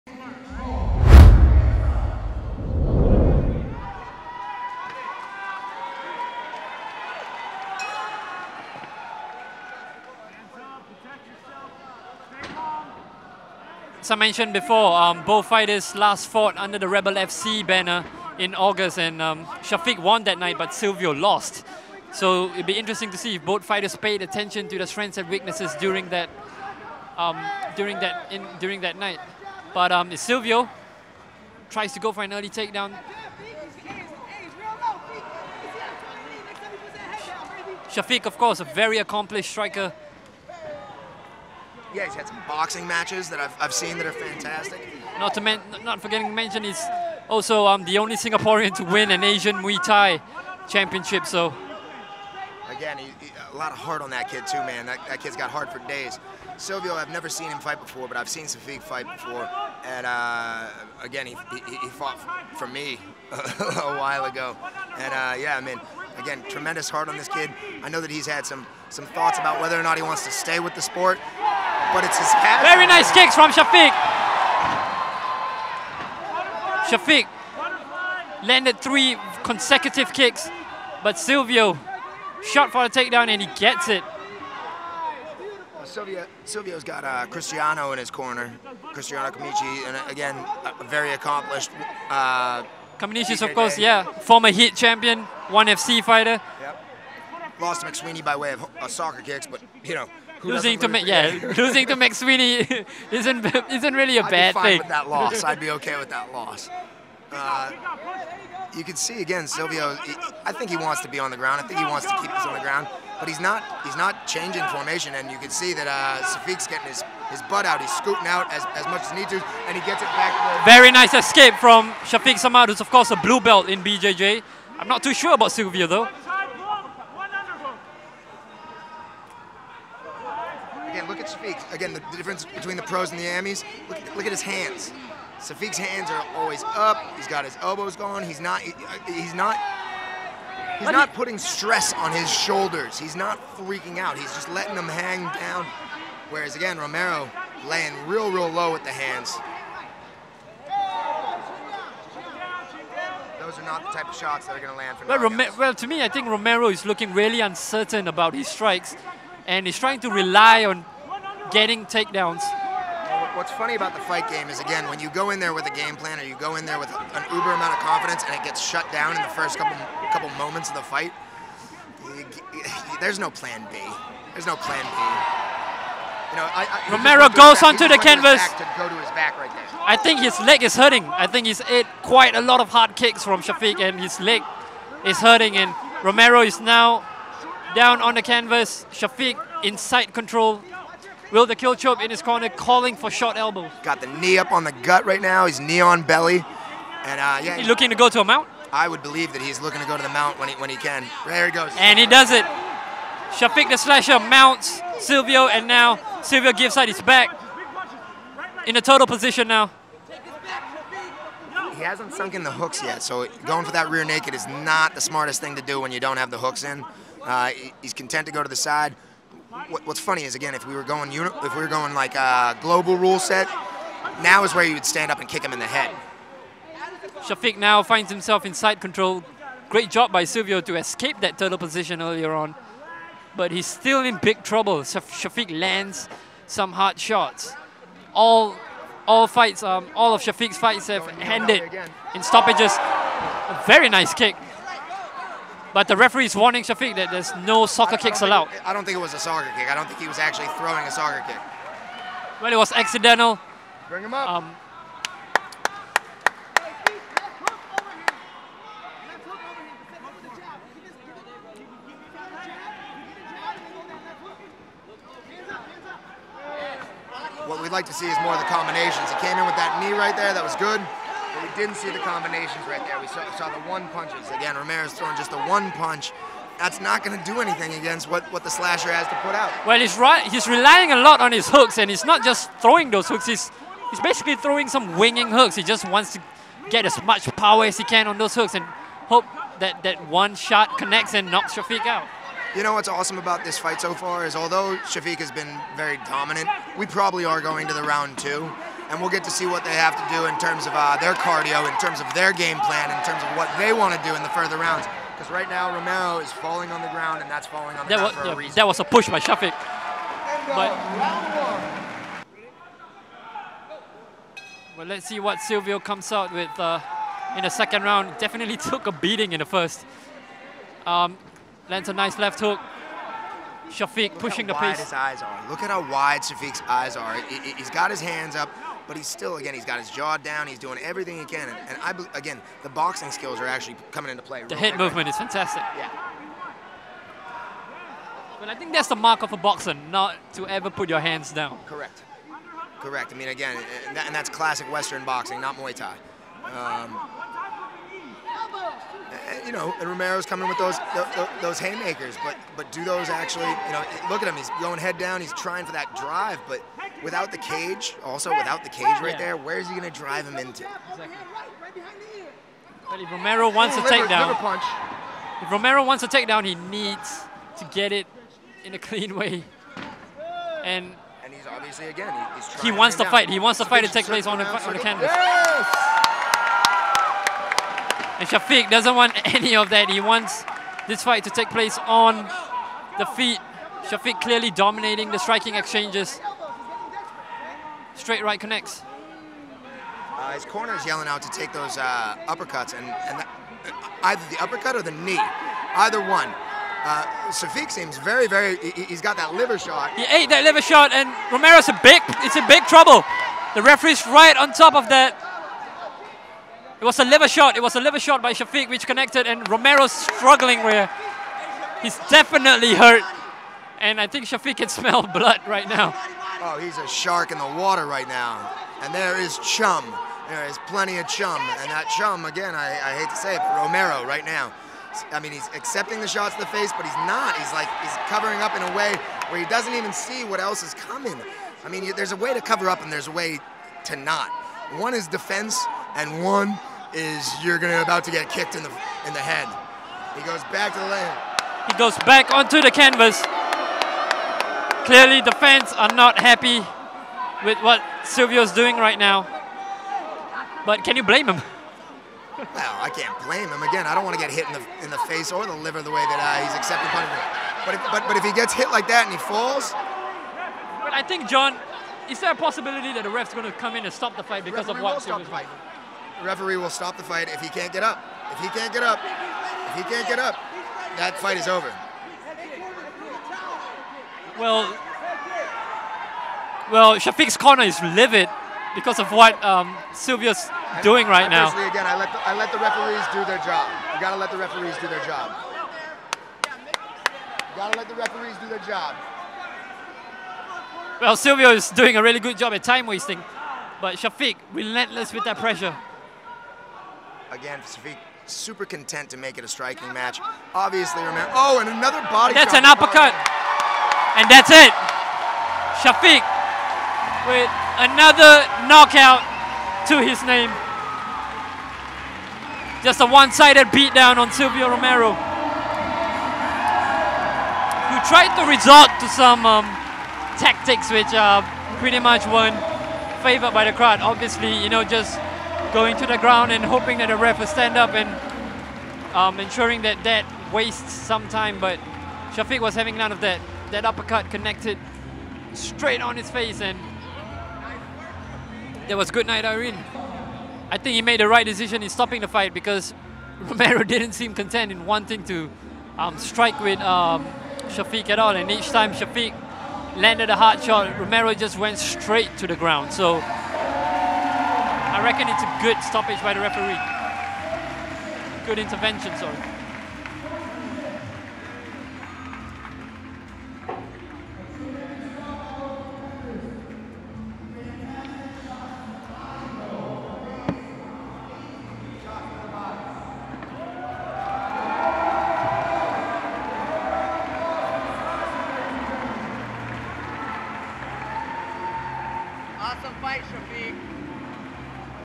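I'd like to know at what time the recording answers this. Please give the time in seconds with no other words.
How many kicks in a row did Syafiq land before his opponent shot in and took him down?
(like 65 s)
78 s.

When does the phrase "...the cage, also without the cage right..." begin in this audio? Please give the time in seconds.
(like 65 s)
357 s.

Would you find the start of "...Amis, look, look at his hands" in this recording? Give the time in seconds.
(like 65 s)
133 s.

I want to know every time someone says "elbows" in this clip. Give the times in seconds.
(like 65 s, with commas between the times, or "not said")
137 s, 193 s.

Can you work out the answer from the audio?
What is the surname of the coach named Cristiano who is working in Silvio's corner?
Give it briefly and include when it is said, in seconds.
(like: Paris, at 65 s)
Kaminishi, at 89 s.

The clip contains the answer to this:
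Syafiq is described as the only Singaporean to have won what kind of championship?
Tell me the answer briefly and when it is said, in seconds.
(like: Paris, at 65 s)
Asian Muay Thai championship, at 49 s.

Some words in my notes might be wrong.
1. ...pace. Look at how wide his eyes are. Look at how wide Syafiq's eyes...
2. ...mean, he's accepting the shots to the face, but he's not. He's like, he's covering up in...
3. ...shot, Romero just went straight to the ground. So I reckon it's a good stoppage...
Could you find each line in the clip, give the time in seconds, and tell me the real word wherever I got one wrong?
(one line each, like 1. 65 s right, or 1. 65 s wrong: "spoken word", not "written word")
1. 324 s right
2. 425 s right
3. 550 s right.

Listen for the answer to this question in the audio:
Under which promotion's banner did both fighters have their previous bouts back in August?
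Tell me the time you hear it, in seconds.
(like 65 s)
16 s.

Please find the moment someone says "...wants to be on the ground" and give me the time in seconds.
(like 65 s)
110 s.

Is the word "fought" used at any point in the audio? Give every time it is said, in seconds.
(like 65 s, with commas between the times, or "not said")
16 s, 61 s.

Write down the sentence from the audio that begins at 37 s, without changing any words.
Syafiq, of course, a very accomplished striker yeah, he's had some boxing matches that I've, I've seen that are fantastic.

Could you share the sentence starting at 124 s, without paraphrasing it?
I'm not too sure about Silvio though.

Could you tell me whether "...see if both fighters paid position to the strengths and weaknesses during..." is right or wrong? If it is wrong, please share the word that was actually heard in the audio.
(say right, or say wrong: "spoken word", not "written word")
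wrong: "attention", not "position".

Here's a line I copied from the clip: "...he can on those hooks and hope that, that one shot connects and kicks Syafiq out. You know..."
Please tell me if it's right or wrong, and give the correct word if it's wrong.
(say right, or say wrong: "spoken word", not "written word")
wrong: "knocks", not "kicks".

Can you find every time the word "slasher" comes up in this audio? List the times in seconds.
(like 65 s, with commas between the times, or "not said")
203 s, 278 s.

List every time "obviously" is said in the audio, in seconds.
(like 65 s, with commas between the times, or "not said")
371 s, 500 s, 524 s.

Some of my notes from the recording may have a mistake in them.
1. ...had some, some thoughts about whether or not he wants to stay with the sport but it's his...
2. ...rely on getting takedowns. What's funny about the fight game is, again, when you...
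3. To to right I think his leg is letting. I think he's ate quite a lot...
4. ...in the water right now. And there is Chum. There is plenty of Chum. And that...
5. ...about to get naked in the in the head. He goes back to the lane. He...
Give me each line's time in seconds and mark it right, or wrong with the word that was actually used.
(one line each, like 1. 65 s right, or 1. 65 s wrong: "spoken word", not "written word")
1. 68 s right
2. 160 s right
3. 178 s wrong: "hurting", not "letting"
4. 417 s right
5. 437 s wrong: "kicked", not "naked".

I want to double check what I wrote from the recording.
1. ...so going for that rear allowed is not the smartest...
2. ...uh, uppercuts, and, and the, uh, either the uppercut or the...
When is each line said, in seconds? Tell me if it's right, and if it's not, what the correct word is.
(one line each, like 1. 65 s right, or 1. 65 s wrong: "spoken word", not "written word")
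1. 213 s wrong: "naked", not "allowed"
2. 391 s right.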